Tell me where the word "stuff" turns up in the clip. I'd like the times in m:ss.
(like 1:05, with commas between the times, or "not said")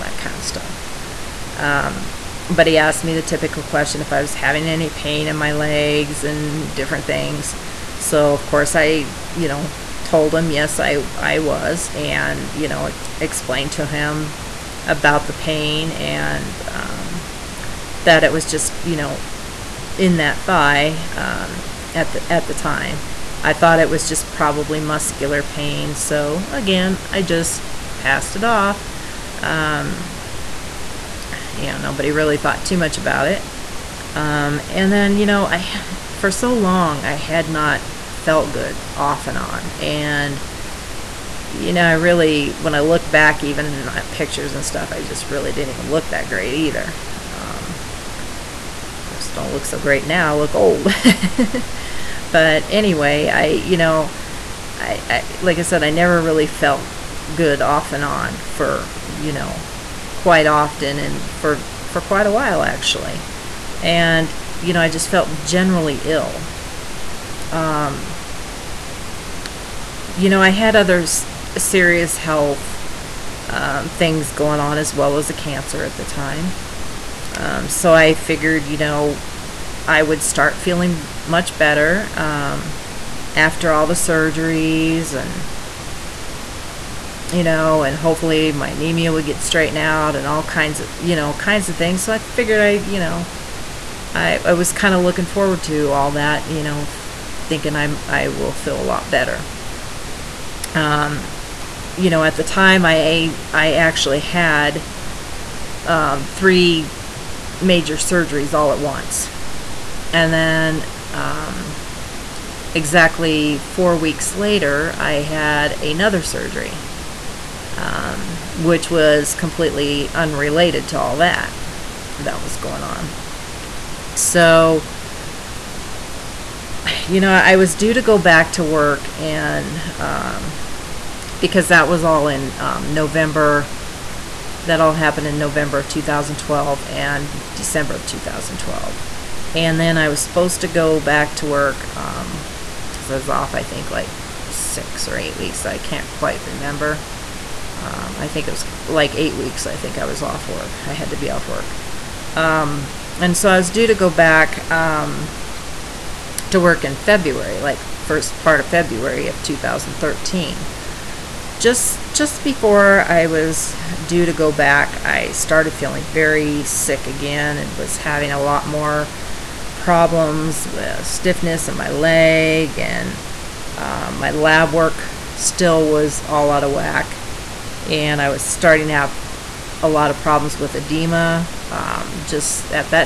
0:00, 0:44.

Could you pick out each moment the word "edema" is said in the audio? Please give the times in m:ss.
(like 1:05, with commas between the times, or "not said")
3:00.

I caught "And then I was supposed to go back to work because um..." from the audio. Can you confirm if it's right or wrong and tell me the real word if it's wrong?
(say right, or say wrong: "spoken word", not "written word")
right.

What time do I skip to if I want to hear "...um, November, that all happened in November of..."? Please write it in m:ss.
2:12.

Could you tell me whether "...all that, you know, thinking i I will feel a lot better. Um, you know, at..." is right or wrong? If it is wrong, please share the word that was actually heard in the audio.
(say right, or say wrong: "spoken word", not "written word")
right.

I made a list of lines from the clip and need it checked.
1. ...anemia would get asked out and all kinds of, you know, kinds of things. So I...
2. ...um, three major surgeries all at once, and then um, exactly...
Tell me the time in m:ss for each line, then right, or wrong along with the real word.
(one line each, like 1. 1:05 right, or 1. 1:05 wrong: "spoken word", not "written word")
1. 1:28 wrong: "straightened", not "asked"
2. 1:45 right.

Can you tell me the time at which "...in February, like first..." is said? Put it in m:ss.
2:36.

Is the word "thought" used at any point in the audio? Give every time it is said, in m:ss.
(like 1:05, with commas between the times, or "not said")
0:23, 0:32.